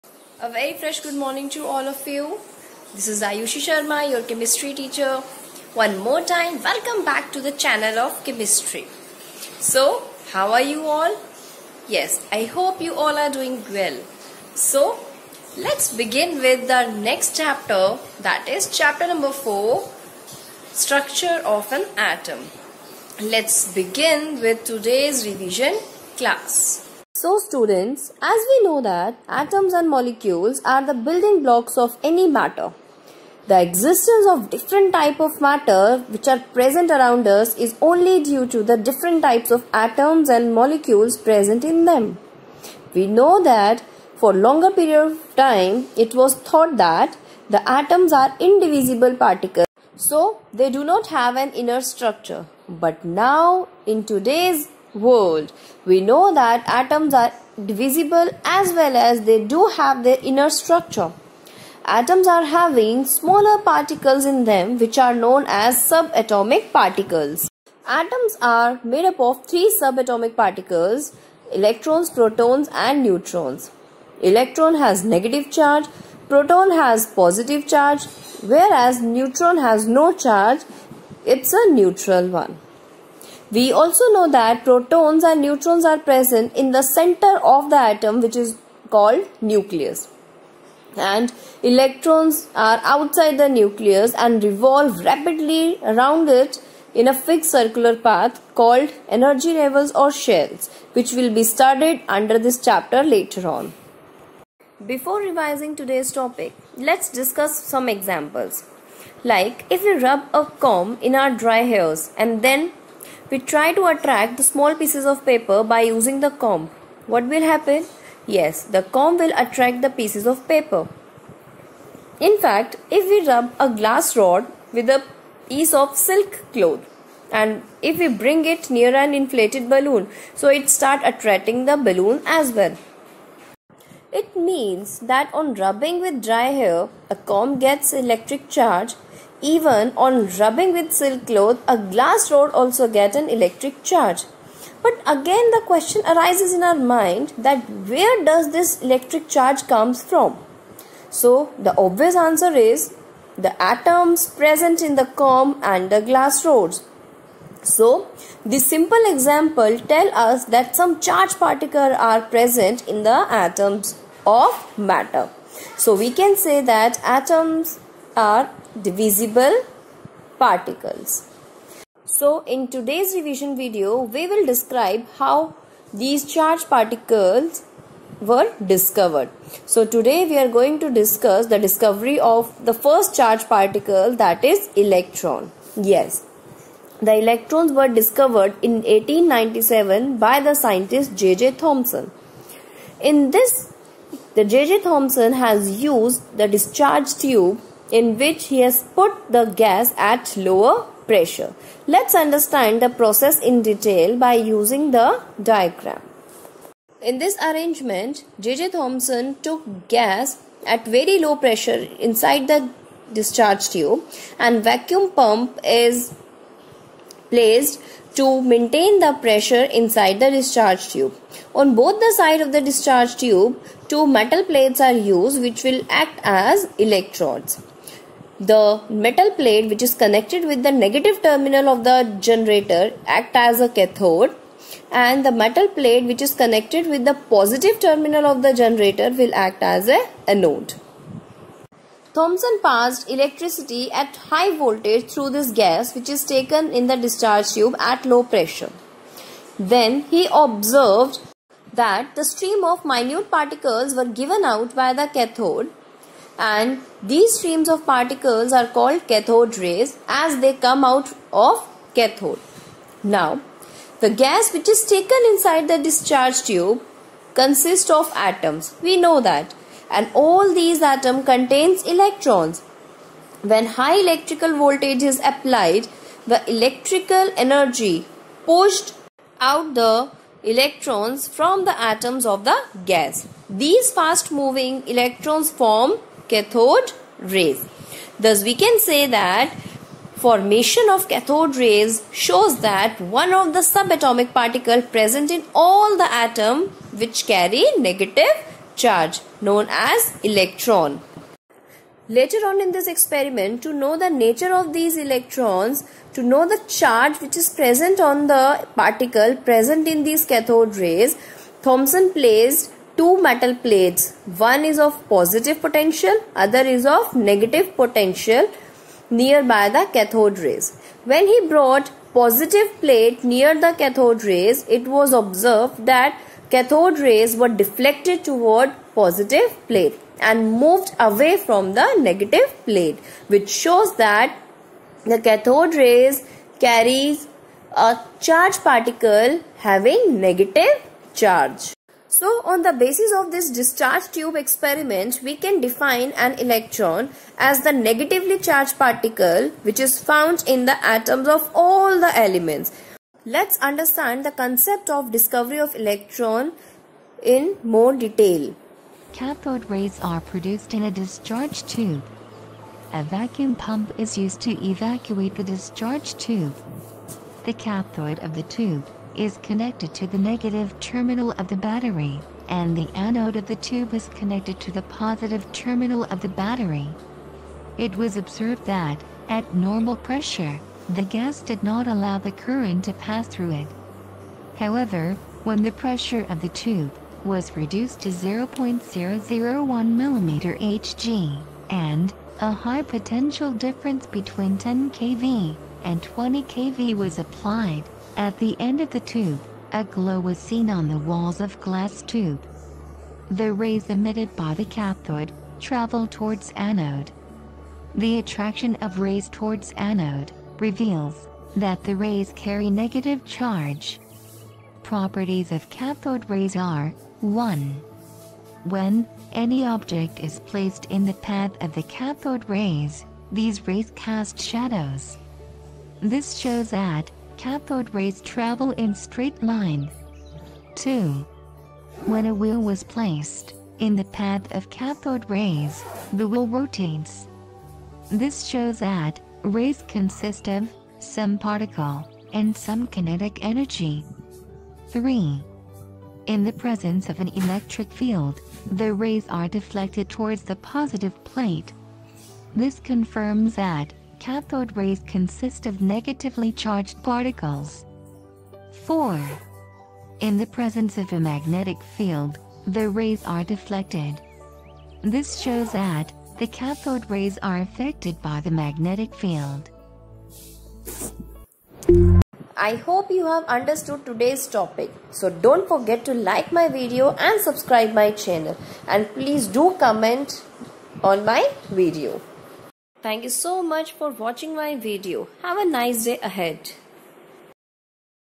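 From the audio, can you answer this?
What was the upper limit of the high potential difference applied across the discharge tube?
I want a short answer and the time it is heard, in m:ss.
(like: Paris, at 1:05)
20 kV, at 6:36.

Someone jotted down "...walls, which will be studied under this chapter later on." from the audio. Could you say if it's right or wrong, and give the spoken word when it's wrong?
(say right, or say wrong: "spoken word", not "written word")
wrong: "shells", not "walls".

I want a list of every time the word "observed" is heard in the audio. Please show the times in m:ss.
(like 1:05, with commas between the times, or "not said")
4:10, 5:25, 6:18.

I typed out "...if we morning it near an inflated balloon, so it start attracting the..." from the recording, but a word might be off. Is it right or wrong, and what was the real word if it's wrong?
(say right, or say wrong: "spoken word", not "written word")
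wrong: "bring", not "morning".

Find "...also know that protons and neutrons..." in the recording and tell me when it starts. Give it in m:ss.
1:23.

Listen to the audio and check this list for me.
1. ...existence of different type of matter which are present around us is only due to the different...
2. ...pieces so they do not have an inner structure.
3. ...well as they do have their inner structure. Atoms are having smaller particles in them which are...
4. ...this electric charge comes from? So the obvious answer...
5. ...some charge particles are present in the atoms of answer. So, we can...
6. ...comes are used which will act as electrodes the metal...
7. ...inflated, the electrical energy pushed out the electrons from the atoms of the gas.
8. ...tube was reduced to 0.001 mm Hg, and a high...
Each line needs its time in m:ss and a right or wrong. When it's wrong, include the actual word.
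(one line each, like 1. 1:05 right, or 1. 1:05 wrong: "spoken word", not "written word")
1. 0:33 right
2. 0:49 wrong: "particles", not "pieces"
3. 0:58 right
4. 2:28 right
5. 2:40 wrong: "matter", not "answer"
6. 3:44 wrong: "plates", not "comes"
7. 4:35 wrong: "applied", not "inflated"
8. 6:26 right.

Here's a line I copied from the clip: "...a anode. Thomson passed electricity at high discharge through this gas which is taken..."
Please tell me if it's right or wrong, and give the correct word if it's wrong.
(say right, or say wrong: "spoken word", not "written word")
wrong: "voltage", not "discharge".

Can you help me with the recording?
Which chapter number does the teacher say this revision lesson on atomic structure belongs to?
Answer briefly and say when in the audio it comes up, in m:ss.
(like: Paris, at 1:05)
4, at 0:18.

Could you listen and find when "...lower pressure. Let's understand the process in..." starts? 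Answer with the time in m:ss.
3:20.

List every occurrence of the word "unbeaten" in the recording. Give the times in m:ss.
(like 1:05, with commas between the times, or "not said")
not said.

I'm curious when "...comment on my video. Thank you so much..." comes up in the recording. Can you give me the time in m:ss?
7:59.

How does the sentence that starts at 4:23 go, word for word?
Now, the gas which is taken inside the discharge tube consists of atoms.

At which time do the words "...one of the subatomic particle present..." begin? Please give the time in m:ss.
4:53.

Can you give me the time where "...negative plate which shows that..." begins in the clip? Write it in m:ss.
5:32.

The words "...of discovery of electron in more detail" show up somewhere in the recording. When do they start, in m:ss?
5:54.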